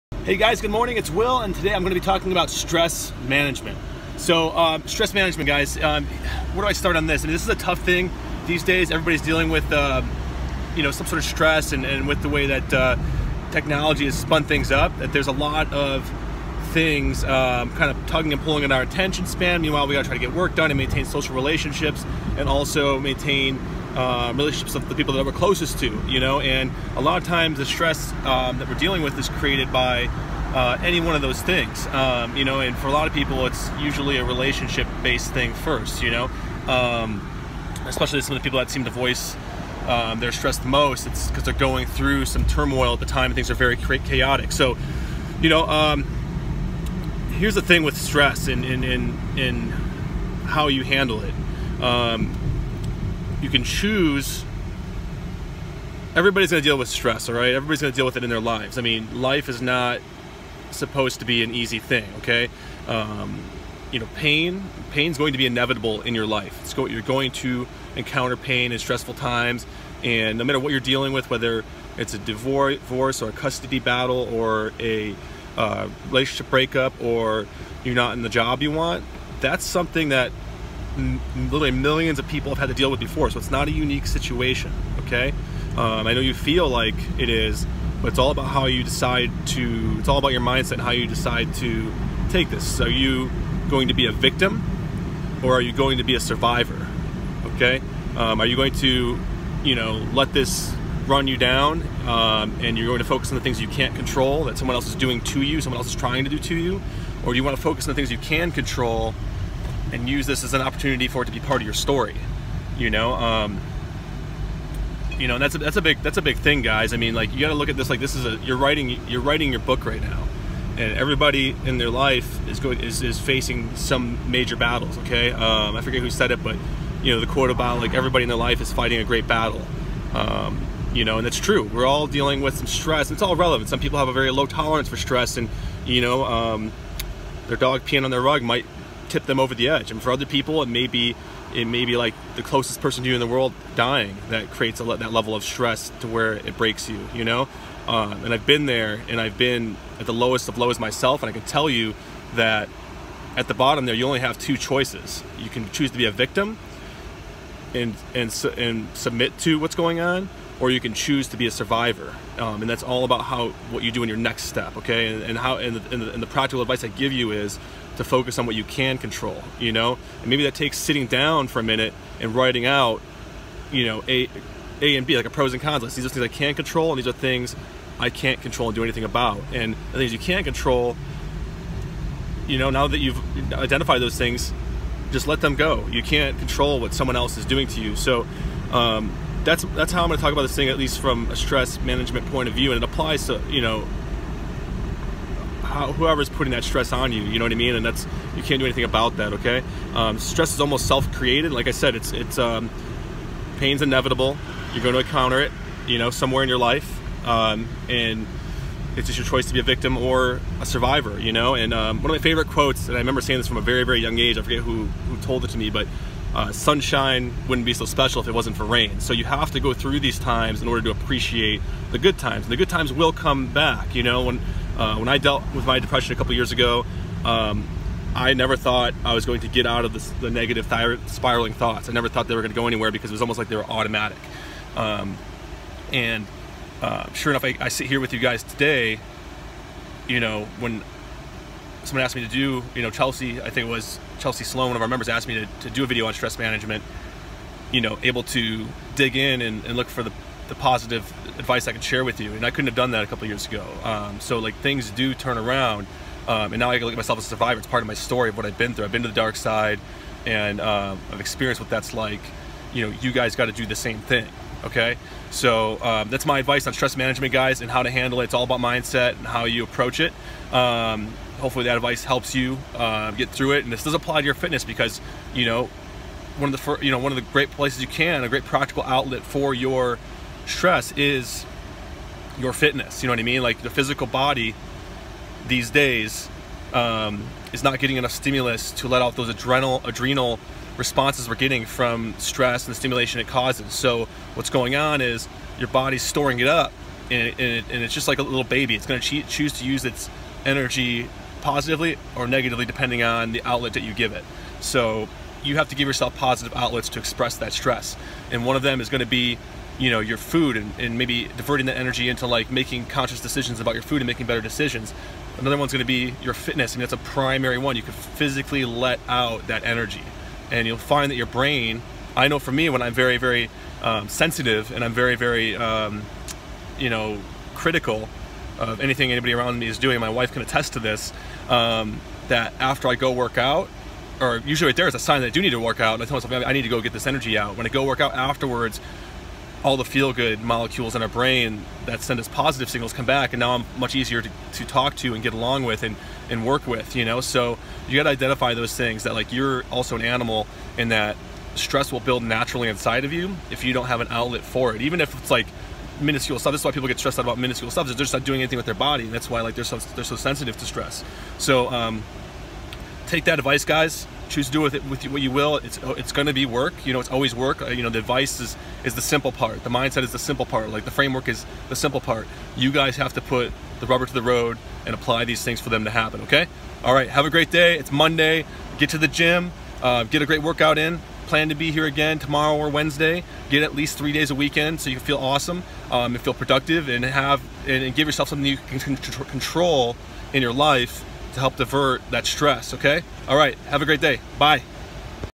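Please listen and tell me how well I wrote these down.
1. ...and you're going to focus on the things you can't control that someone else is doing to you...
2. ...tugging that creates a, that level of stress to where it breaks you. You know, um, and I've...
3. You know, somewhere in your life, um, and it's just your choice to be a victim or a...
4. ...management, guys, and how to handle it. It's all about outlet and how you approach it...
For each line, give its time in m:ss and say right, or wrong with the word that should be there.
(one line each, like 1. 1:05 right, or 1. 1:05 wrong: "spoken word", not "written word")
1. 1:42 right
2. 2:23 wrong: "dying", not "tugging"
3. 3:25 right
4. 4:26 wrong: "mindset", not "outlet".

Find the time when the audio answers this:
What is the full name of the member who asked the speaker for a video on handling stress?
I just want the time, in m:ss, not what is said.
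4:04.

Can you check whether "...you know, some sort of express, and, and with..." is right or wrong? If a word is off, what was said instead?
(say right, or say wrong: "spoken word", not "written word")
wrong: "stress", not "express".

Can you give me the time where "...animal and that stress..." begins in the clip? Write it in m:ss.
5:50.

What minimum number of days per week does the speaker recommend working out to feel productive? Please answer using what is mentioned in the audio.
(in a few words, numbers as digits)
3.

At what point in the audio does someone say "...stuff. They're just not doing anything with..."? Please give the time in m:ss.
5:57.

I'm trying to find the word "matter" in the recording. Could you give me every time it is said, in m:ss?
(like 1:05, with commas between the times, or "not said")
1:10.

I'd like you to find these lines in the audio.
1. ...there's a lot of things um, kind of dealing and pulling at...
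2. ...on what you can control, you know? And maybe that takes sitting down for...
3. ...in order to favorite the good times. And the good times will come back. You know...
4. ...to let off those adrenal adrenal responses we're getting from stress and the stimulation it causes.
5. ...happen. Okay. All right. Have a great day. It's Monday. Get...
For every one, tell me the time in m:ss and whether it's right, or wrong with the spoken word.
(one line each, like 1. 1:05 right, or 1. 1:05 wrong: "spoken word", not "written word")
1. 0:15 wrong: "tugging", not "dealing"
2. 2:48 right
3. 3:40 wrong: "appreciate", not "favorite"
4. 4:48 right
5. 6:15 right.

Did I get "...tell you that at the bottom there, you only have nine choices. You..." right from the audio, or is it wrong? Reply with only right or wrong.
wrong.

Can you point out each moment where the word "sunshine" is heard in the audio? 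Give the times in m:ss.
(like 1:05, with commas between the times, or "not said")
3:36.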